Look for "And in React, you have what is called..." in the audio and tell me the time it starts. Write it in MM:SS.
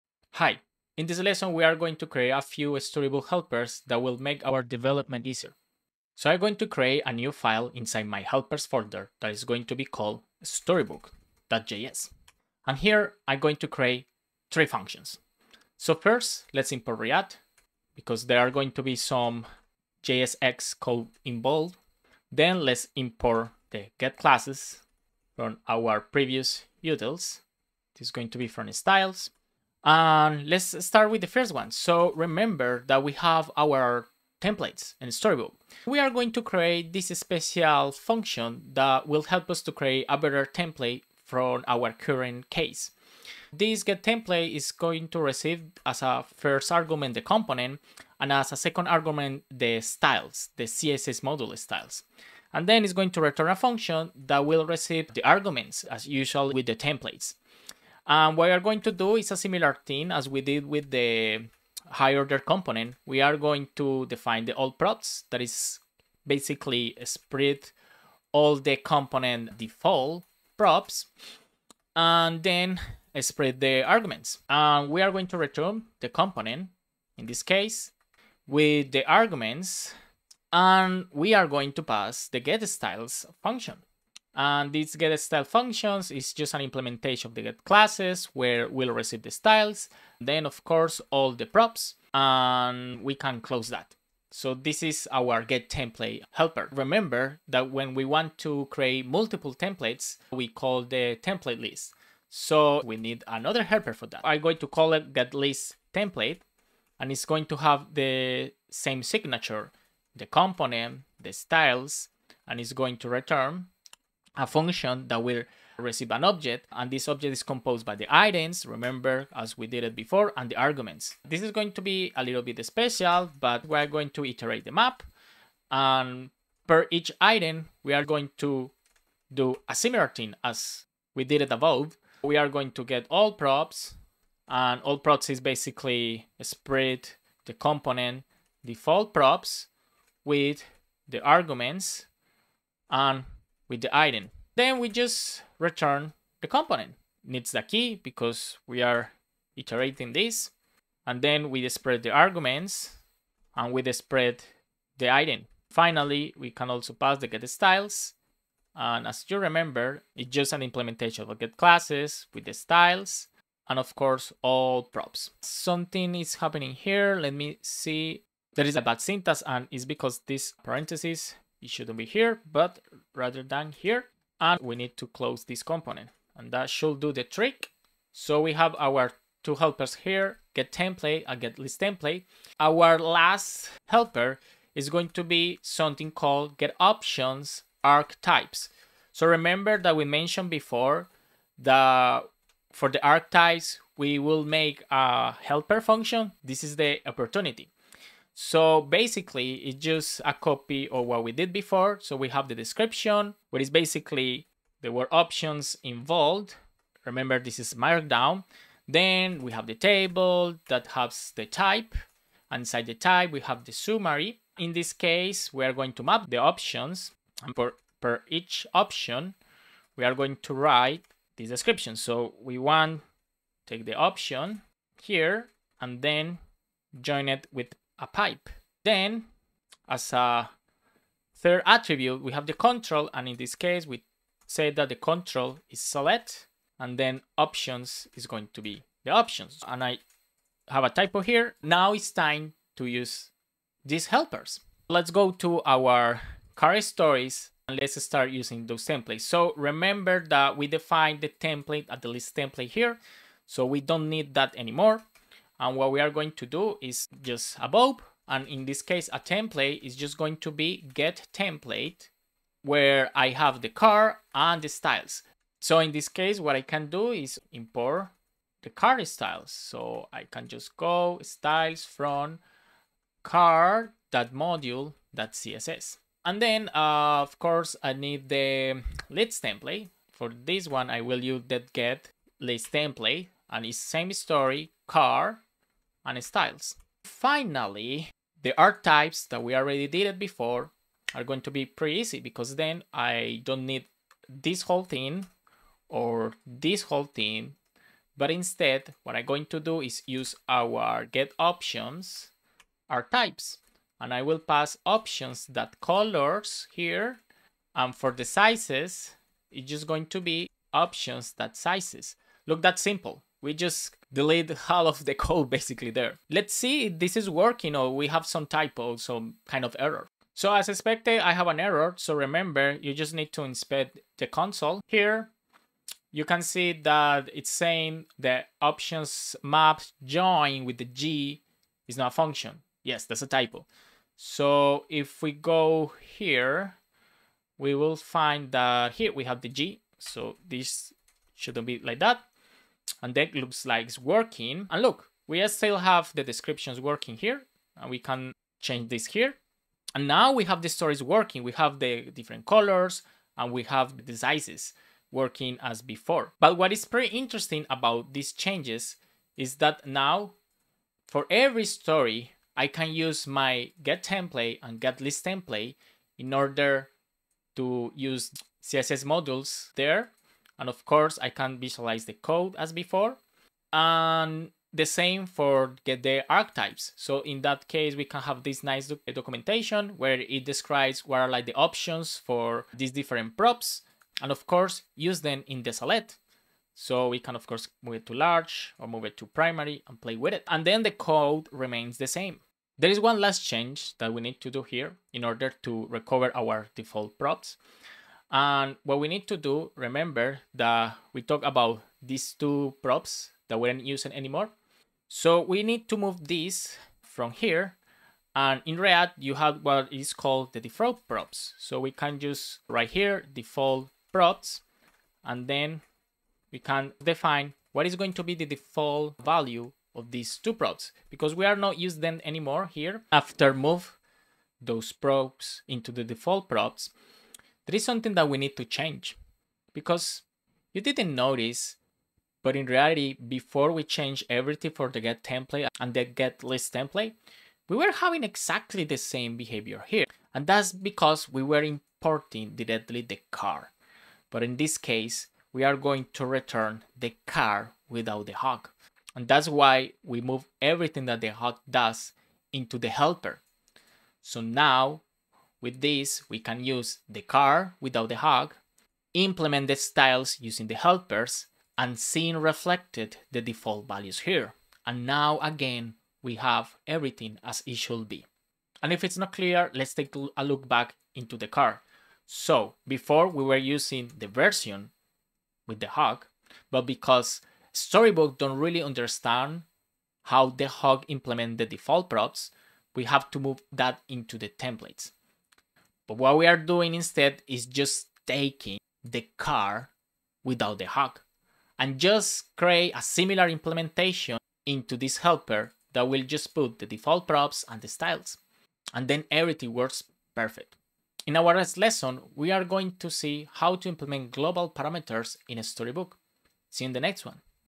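06:48.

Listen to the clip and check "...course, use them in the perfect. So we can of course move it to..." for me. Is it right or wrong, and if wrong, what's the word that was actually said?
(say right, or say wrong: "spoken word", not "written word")
wrong: "select", not "perfect".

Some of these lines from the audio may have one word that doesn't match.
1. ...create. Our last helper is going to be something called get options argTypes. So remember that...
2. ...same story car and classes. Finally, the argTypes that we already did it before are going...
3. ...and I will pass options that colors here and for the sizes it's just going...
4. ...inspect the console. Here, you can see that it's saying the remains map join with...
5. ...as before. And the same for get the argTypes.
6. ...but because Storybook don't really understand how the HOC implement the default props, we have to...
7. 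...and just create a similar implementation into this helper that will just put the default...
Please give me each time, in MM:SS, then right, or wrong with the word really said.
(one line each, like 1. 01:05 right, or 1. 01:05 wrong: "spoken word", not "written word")
1. 03:01 wrong: "template", not "create"
2. 04:43 wrong: "styles", not "classes"
3. 05:04 right
4. 05:23 wrong: "options", not "remains"
5. 06:12 right
6. 07:56 right
7. 08:11 right.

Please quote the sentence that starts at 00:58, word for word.
And um, what we are going to do is a similar thing as we did with the high order component.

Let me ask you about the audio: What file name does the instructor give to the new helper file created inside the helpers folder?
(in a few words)
storybook.js.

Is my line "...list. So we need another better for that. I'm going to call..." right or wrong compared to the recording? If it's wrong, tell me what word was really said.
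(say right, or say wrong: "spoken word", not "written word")
wrong: "helper", not "better".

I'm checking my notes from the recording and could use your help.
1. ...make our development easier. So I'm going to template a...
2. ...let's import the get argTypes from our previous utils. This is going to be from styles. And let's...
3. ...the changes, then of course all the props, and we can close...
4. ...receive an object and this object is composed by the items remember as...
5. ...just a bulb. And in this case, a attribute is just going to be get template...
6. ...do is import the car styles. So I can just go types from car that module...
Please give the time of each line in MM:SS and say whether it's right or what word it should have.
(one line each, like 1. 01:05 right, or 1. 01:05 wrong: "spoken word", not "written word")
1. 00:04 wrong: "create", not "template"
2. 00:22 wrong: "classes", not "argTypes"
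3. 01:29 wrong: "styles", not "changes"
4. 01:55 right
5. 04:17 wrong: "template", not "attribute"
6. 04:26 wrong: "styles", not "types".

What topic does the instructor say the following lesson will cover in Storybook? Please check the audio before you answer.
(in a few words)
global parameters.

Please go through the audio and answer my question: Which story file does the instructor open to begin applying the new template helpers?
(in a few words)
car stories.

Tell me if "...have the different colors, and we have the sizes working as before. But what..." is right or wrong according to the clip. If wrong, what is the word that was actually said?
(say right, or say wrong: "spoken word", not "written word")
right.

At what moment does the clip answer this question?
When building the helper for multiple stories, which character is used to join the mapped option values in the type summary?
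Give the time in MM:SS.
03:48.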